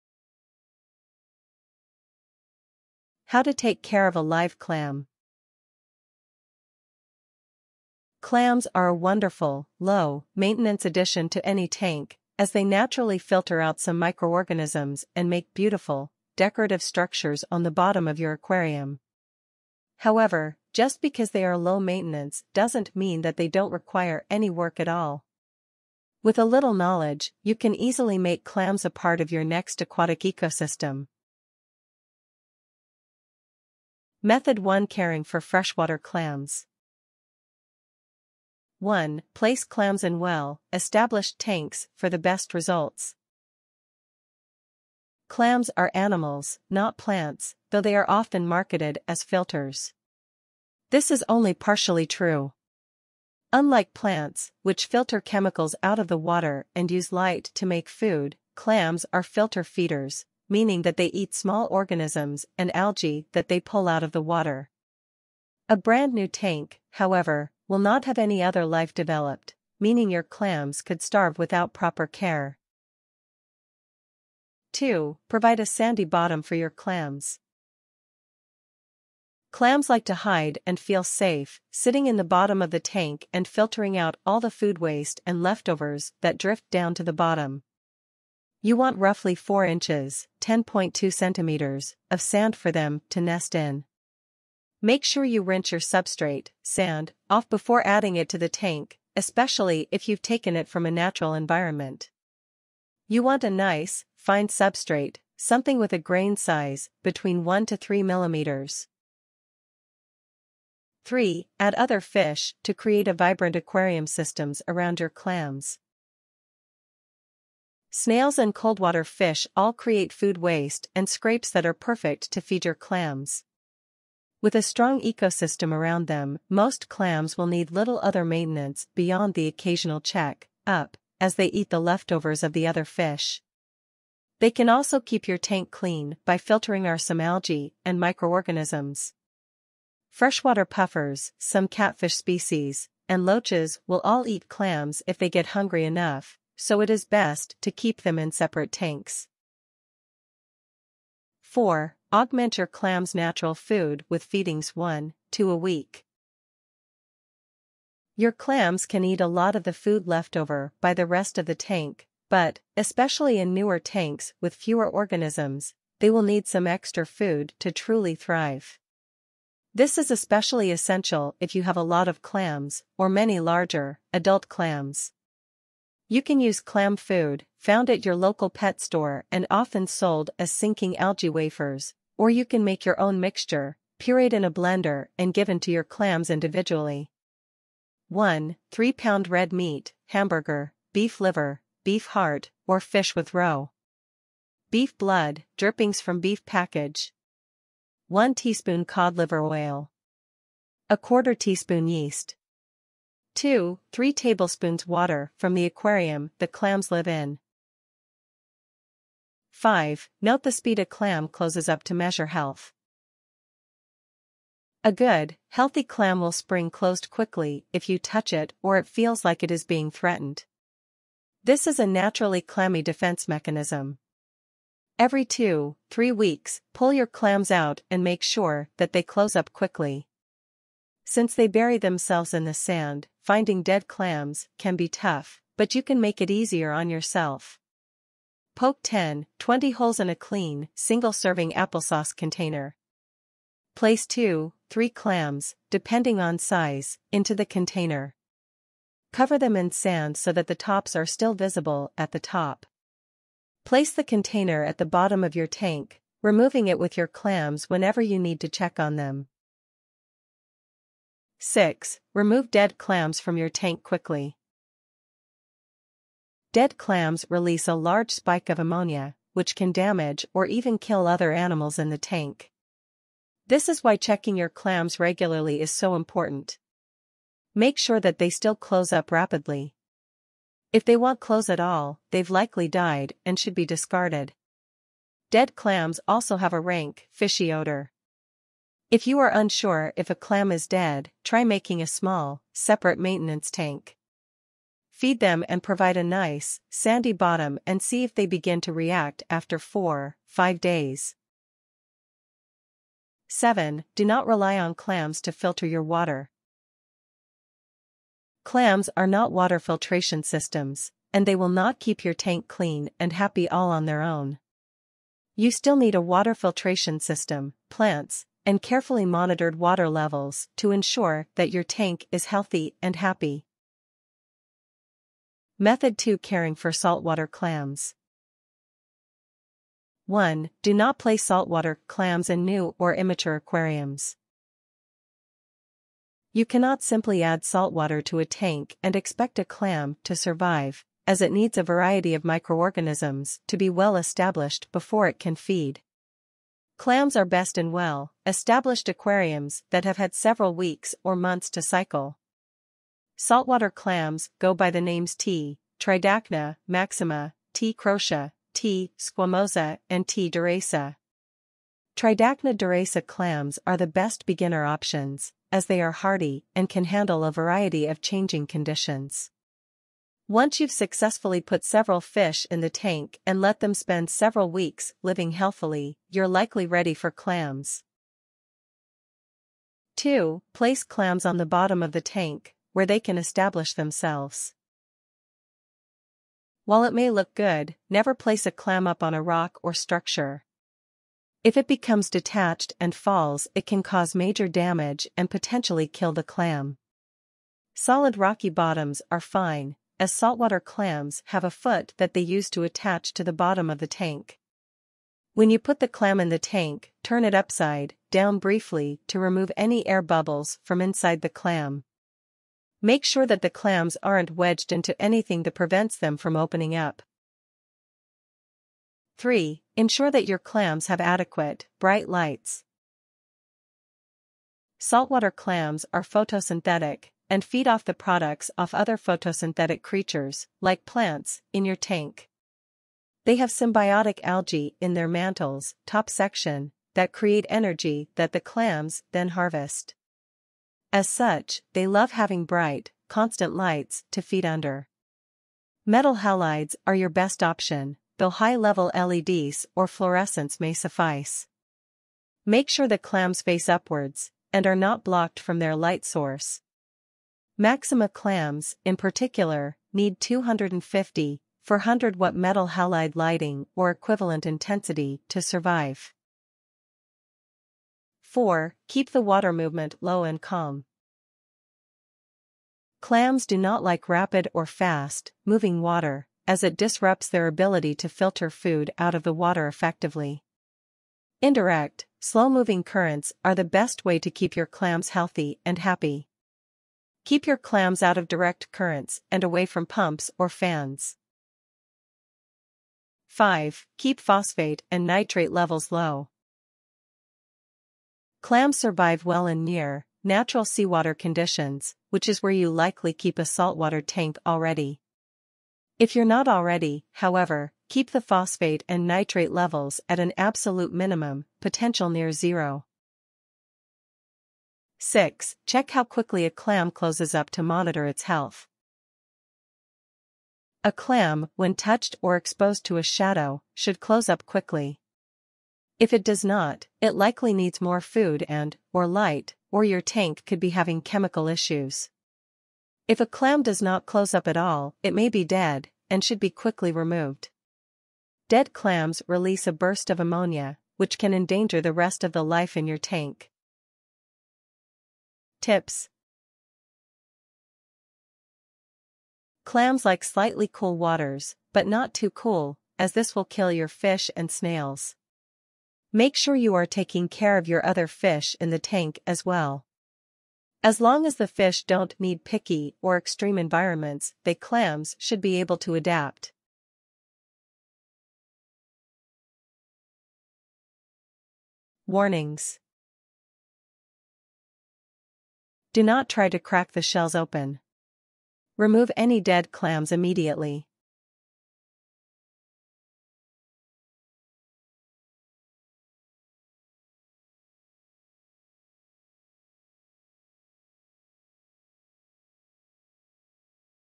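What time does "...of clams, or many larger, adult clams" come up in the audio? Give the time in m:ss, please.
2:52.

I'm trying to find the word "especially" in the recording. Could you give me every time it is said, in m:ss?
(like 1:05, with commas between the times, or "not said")
1:39, 2:42, 2:50.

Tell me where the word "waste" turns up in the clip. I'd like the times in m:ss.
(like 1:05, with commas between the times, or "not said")
1:24, 2:00.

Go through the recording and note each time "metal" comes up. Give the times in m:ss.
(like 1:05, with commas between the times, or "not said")
7:25, 7:42.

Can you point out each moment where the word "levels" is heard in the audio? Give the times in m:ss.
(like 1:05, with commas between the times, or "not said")
5:19, 7:28, 8:15, 8:29.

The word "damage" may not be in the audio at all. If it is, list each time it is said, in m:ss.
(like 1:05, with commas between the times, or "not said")
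4:29, 6:34.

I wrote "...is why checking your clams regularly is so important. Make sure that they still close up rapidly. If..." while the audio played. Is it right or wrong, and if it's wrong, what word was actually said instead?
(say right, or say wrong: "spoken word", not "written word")
right.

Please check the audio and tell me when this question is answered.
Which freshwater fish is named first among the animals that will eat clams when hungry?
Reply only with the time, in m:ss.
2:20.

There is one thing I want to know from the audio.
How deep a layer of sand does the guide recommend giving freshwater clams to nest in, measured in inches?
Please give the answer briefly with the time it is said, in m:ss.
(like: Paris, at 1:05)
4 inches, at 1:28.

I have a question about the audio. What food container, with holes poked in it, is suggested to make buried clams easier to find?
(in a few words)
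single-serving applesauce container.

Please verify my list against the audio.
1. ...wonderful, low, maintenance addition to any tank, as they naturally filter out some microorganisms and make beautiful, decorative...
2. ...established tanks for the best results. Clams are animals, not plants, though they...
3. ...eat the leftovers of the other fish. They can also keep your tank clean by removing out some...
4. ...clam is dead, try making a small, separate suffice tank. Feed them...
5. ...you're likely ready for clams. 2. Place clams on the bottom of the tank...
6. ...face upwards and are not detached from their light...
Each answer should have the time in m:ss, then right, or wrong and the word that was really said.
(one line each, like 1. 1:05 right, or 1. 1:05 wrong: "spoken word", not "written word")
1. 0:08 right
2. 0:40 right
3. 2:11 wrong: "filtering", not "removing"
4. 4:50 wrong: "maintenance", not "suffice"
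5. 6:16 right
6. 7:33 wrong: "blocked", not "detached".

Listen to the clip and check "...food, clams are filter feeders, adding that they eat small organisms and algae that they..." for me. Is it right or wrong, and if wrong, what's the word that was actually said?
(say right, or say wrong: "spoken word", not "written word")
wrong: "meaning", not "adding".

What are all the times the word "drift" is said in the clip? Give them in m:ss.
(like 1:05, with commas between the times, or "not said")
1:26.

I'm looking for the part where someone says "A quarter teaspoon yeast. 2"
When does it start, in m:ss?
3:20.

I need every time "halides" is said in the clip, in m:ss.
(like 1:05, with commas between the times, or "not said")
7:26, 7:42.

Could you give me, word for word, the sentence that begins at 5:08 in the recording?
Clams are not water filtration systems, and they will not keep your tank clean and happy all on their own.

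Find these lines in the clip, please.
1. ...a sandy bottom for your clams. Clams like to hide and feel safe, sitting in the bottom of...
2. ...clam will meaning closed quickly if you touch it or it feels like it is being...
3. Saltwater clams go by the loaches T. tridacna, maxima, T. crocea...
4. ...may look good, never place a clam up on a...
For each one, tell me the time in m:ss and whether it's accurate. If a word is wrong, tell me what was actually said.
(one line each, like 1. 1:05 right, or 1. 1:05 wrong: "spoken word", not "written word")
1. 1:15 right
2. 3:35 wrong: "spring", not "meaning"
3. 5:53 wrong: "names", not "loaches"
4. 6:26 right.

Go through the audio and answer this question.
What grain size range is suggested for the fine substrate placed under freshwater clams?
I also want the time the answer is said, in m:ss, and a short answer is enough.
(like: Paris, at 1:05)
1 to 3 millimeters, at 1:47.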